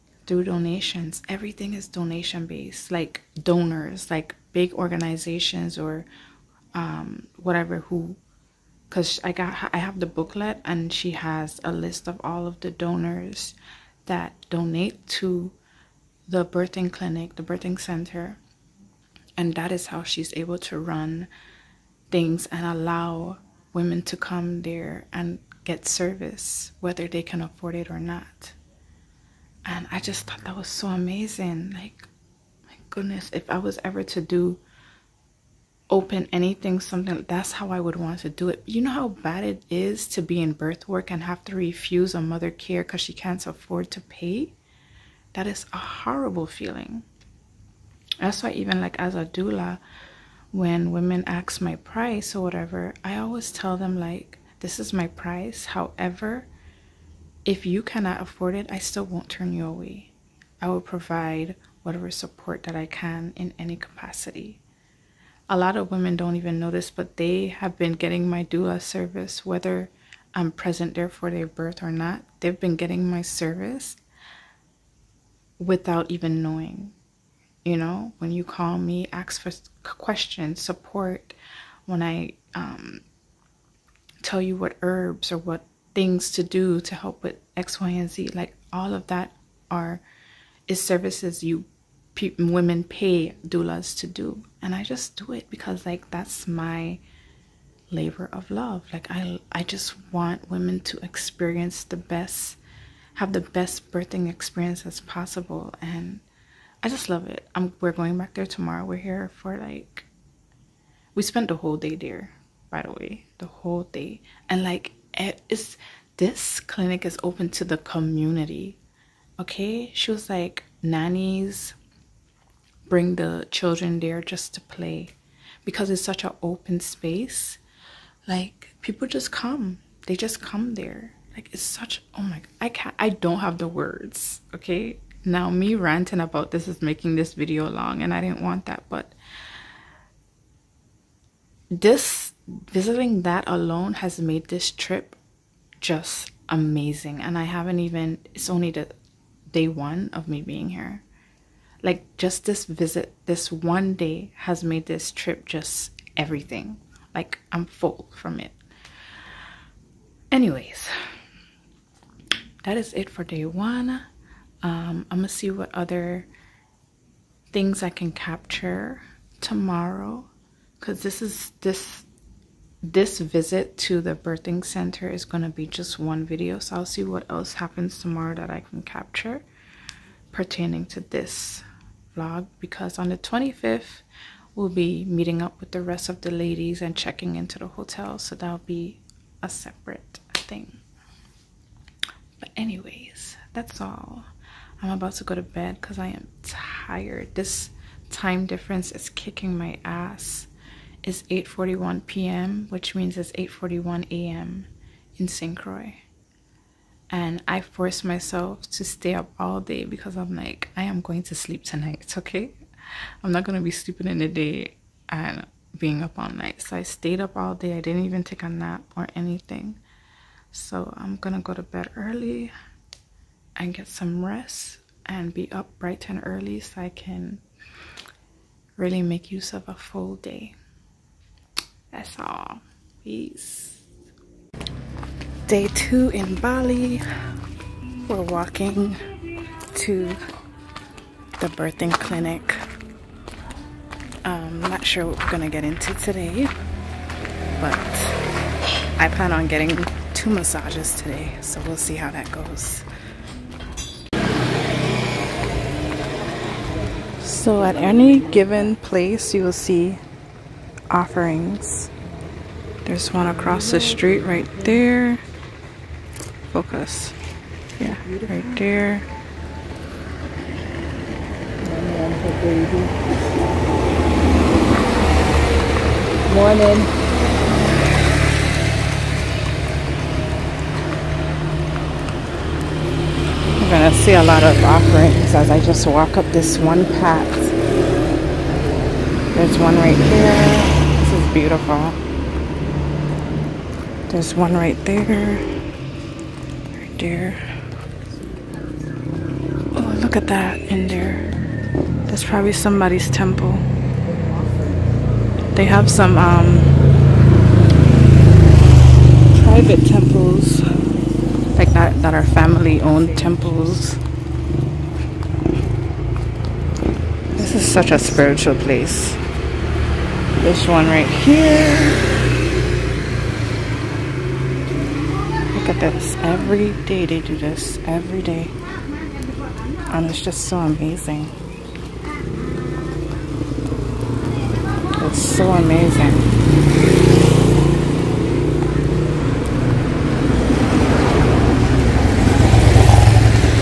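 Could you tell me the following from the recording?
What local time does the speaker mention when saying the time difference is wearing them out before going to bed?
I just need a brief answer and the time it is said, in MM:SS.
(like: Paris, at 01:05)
8:41 p.m., at 03:21.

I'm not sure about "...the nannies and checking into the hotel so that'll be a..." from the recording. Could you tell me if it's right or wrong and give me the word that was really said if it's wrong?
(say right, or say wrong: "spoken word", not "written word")
wrong: "ladies", not "nannies".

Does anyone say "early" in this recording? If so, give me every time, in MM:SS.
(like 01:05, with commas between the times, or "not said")
03:41, 03:46.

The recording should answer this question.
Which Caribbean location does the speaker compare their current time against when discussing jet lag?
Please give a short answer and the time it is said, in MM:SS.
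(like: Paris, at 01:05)
St. Croix, at 03:25.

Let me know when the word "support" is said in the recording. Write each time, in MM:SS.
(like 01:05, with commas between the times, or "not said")
01:02, 01:20.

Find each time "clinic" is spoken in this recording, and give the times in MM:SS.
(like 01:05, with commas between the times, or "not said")
00:16, 01:56, 04:01.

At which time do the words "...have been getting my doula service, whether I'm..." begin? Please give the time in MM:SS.
01:07.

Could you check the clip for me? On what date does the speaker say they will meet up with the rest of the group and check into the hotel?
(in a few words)
The 25th.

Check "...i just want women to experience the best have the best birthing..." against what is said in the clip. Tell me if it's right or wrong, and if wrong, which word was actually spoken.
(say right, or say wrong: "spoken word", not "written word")
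right.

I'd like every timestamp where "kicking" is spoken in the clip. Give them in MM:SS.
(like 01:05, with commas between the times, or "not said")
03:19.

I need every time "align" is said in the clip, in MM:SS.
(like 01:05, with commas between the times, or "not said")
not said.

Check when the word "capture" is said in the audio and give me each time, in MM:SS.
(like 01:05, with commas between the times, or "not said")
02:48, 02:58.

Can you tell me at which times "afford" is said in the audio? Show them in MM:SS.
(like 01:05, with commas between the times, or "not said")
00:27, 00:43, 00:58.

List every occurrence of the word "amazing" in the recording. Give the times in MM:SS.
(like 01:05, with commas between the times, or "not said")
00:30, 02:26, 05:30, 05:35.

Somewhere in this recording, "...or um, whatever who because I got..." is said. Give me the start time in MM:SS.
00:05.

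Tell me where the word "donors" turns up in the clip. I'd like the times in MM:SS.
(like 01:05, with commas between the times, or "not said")
00:03, 00:12.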